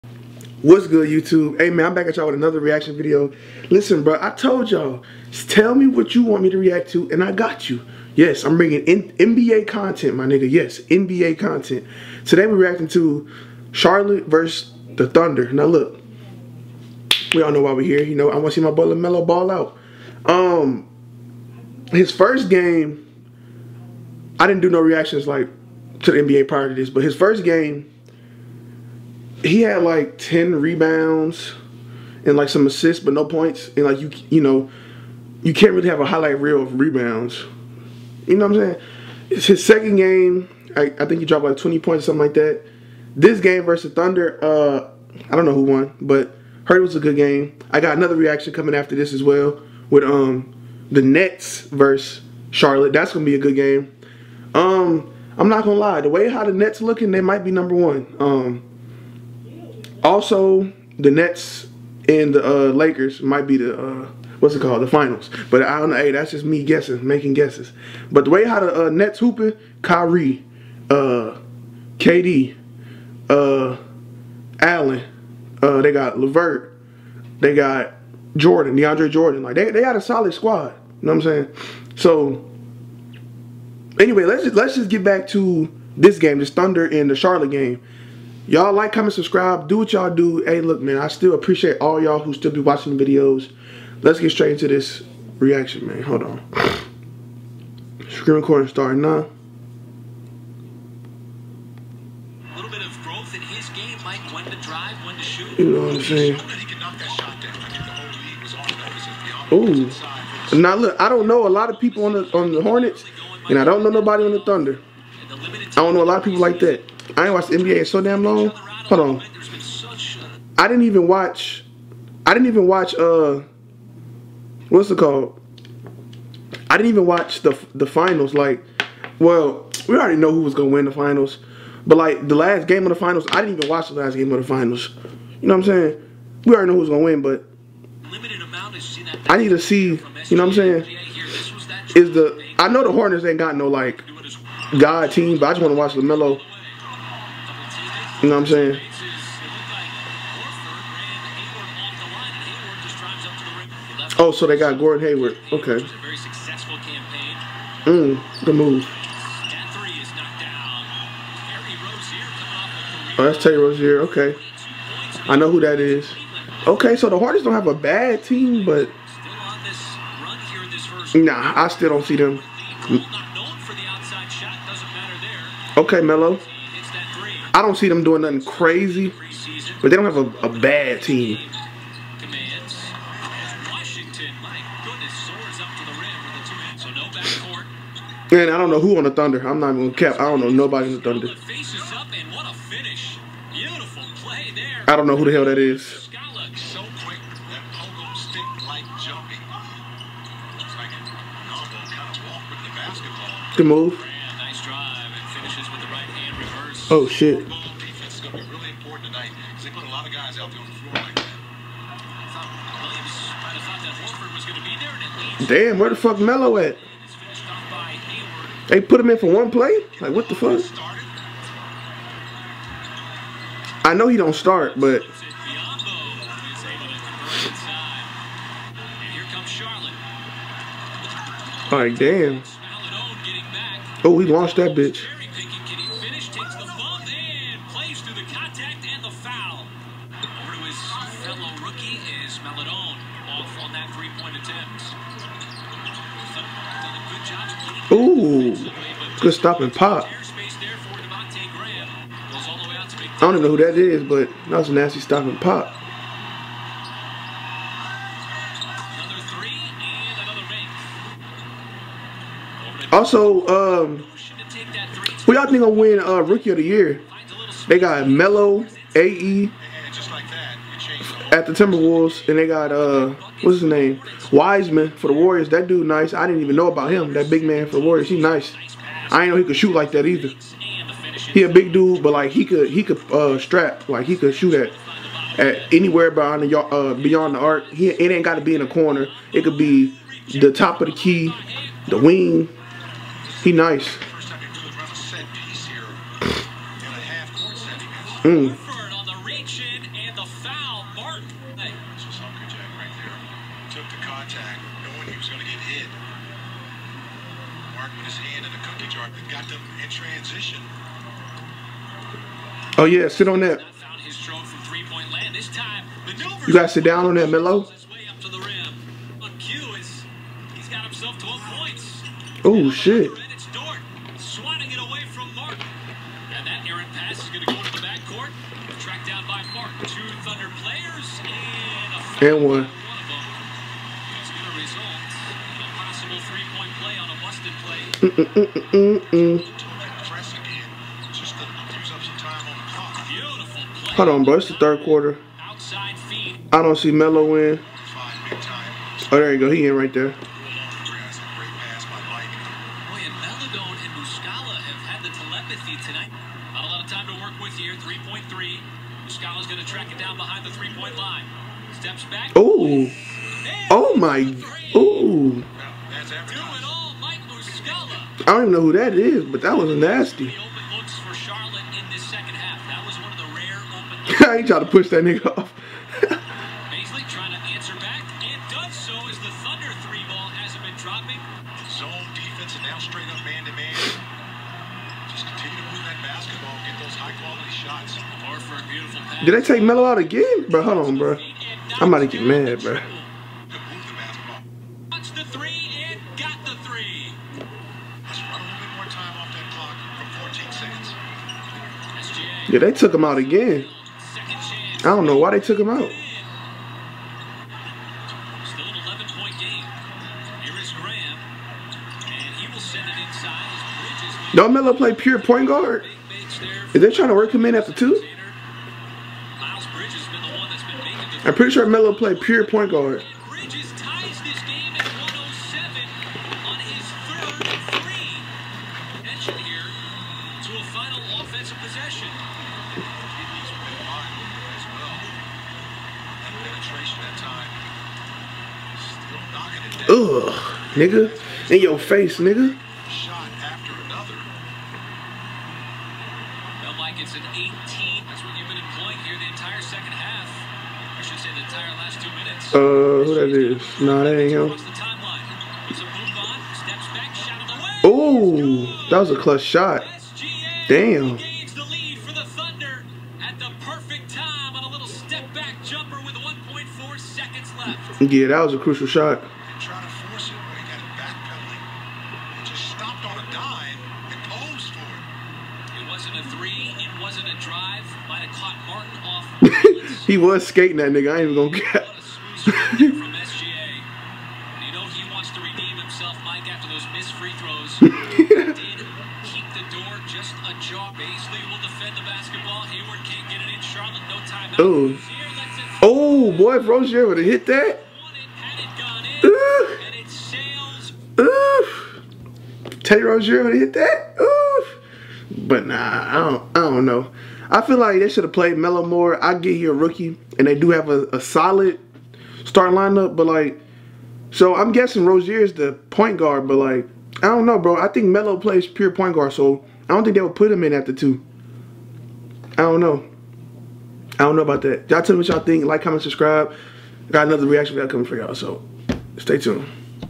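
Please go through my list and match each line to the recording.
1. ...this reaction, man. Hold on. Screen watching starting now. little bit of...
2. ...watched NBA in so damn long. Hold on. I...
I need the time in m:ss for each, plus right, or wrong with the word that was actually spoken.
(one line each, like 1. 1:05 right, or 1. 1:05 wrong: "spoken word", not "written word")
1. 1:34 wrong: "recording", not "watching"
2. 1:57 right.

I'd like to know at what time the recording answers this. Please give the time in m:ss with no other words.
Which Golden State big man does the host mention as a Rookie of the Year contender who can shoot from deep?
4:34.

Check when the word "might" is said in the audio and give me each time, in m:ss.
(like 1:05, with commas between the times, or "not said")
0:57, 1:03.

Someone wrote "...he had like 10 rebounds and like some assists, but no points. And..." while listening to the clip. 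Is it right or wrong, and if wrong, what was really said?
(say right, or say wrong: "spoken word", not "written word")
right.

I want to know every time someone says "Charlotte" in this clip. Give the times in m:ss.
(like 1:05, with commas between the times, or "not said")
0:13, 0:52, 1:27.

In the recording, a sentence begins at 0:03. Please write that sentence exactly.
Listen, bro, I told y'all, tell me what you want me to react to, and I got you.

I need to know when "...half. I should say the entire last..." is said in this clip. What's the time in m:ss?
7:29.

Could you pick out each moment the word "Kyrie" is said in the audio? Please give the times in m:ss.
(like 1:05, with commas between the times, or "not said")
1:09.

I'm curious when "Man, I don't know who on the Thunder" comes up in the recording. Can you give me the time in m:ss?
3:08.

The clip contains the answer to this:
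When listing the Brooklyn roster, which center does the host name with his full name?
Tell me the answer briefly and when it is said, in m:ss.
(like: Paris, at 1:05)
DeAndre Jordan, at 1:18.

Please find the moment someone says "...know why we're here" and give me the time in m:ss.
0:17.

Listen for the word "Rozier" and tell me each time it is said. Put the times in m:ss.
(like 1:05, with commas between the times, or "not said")
2:43, 8:16, 8:23, 8:35.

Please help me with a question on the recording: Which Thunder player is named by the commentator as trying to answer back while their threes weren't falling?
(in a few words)
Bazley.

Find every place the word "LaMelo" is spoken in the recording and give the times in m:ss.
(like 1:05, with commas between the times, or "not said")
0:18, 2:25.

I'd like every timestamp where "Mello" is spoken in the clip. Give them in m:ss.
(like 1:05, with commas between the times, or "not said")
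2:56, 3:36, 4:28.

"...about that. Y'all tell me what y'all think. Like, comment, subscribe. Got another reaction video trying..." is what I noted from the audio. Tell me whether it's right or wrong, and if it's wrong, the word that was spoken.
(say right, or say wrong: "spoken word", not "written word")
wrong: "coming", not "trying".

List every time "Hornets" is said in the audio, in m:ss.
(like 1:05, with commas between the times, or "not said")
1:52, 2:22, 2:47.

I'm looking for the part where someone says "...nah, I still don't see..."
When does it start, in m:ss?
2:51.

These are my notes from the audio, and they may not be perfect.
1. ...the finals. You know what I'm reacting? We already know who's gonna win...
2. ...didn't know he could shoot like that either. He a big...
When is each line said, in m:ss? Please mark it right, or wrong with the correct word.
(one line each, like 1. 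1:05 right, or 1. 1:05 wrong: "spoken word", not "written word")
1. 2:14 wrong: "saying", not "reacting"
2. 4:39 right.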